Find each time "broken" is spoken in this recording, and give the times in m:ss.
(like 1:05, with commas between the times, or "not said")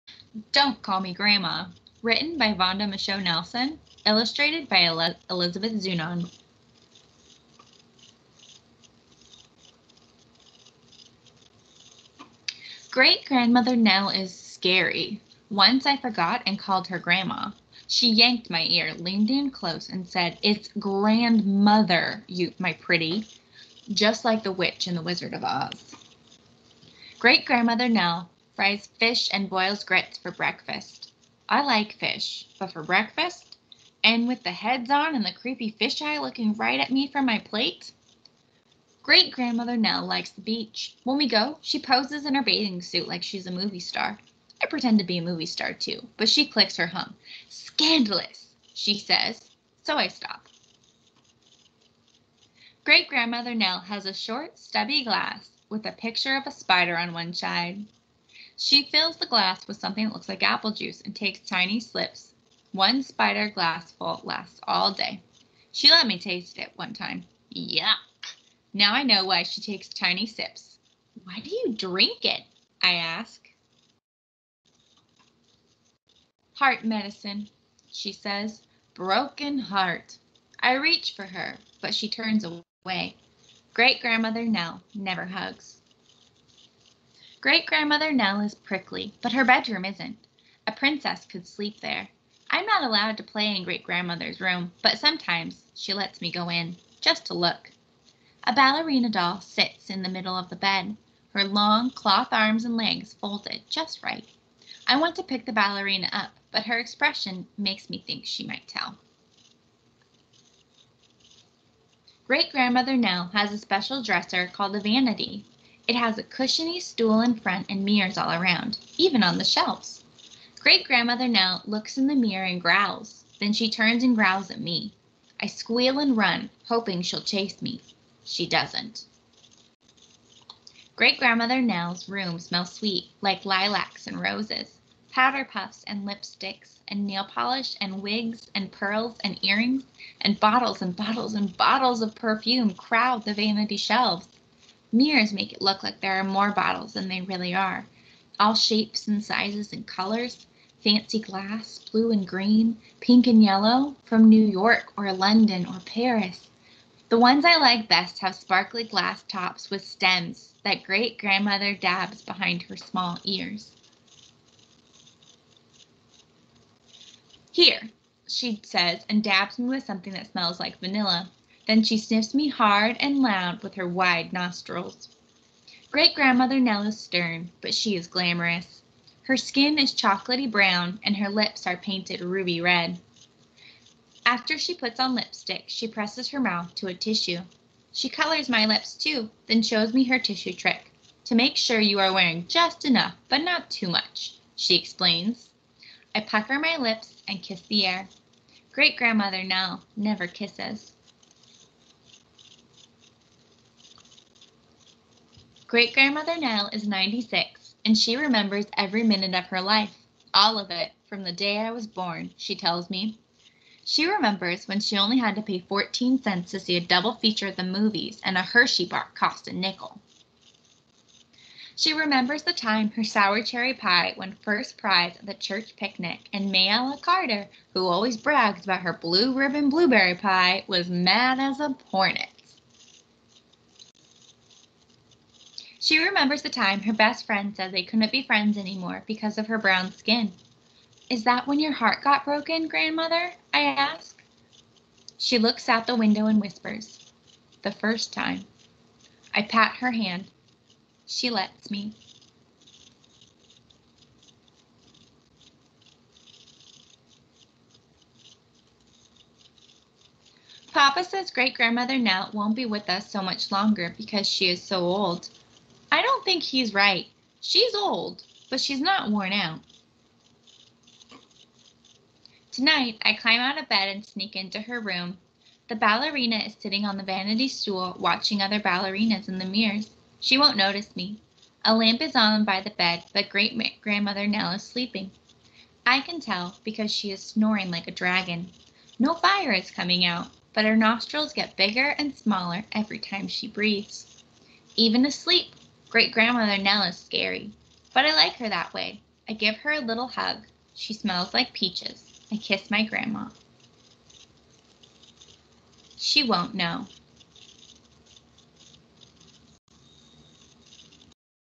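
1:18, 4:02.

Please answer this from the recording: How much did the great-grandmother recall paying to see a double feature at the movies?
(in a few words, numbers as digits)
14 cents.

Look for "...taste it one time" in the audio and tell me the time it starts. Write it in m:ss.
1:06.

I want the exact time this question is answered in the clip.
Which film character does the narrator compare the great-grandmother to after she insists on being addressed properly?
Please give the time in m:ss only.
0:24.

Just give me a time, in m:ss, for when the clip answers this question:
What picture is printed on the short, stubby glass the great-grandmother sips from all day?
0:55.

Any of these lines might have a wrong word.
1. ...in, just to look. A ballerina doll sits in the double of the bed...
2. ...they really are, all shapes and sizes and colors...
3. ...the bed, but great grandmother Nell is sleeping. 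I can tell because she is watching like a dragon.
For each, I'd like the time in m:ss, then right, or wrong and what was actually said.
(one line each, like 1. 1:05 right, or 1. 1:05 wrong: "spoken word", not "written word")
1. 1:36 wrong: "middle", not "double"
2. 2:27 right
3. 4:42 wrong: "snoring", not "watching".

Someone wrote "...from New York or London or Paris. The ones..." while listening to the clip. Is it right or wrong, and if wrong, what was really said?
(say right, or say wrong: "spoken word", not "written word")
right.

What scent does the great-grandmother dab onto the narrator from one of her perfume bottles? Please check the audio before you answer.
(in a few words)
Vanilla.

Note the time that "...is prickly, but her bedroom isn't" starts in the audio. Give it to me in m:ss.
1:28.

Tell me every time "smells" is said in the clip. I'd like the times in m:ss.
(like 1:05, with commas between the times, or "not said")
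2:12, 2:50, 5:00.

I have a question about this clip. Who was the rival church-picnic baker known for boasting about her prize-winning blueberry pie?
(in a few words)
Mayella Carter.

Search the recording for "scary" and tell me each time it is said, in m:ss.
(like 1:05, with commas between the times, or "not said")
0:14, 4:56.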